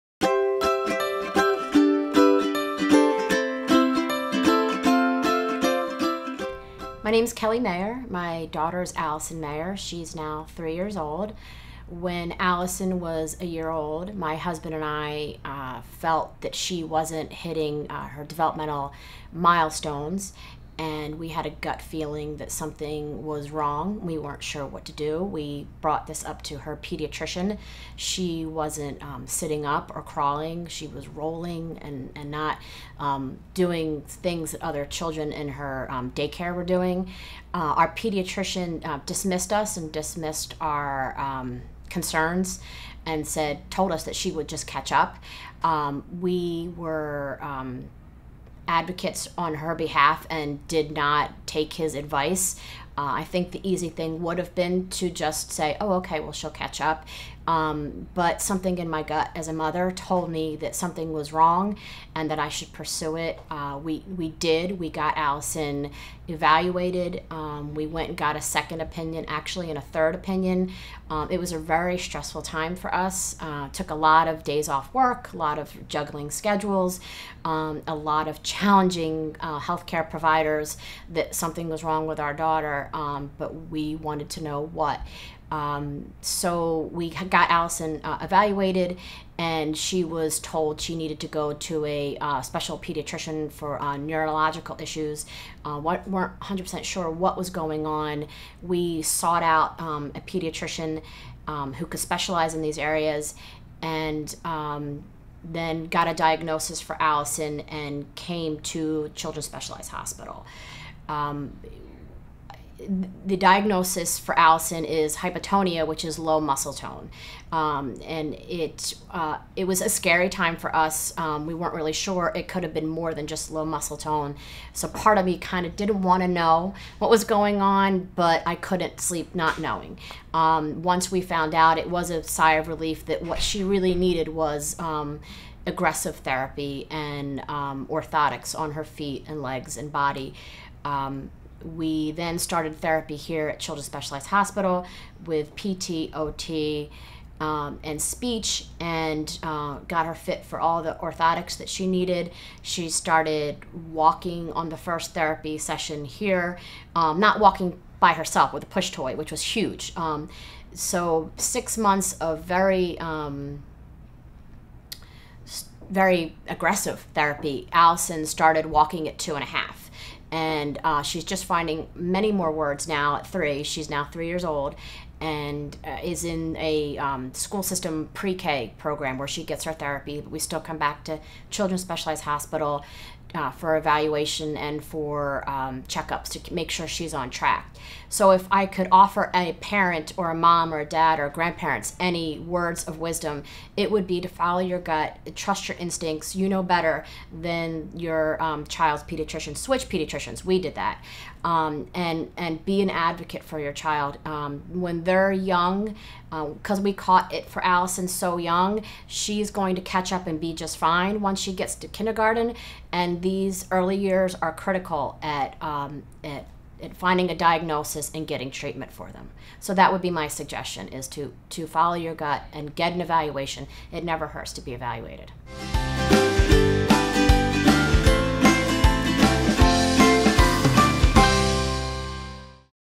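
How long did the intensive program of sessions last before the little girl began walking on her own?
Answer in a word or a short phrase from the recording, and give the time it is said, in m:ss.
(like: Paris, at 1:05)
6 months, at 2:41.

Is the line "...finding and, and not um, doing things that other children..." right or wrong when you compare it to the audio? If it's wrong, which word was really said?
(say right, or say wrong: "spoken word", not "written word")
wrong: "rolling", not "finding".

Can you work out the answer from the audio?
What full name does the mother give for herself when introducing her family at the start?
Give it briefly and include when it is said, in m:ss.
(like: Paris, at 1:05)
Kelly Mayer, at 0:07.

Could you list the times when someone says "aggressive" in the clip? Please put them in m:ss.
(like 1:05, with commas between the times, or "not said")
2:15, 2:46.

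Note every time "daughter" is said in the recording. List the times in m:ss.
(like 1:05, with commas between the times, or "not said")
0:08, 1:22.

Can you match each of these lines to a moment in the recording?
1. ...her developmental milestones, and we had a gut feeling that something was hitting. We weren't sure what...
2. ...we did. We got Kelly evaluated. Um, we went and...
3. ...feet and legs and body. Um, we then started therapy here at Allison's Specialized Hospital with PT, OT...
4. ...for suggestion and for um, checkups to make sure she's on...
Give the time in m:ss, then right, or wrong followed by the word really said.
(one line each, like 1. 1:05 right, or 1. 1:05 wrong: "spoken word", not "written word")
1. 0:18 wrong: "wrong", not "hitting"
2. 1:04 wrong: "Allison", not "Kelly"
3. 2:18 wrong: "Children", not "Allison"
4. 3:03 wrong: "evaluation", not "suggestion".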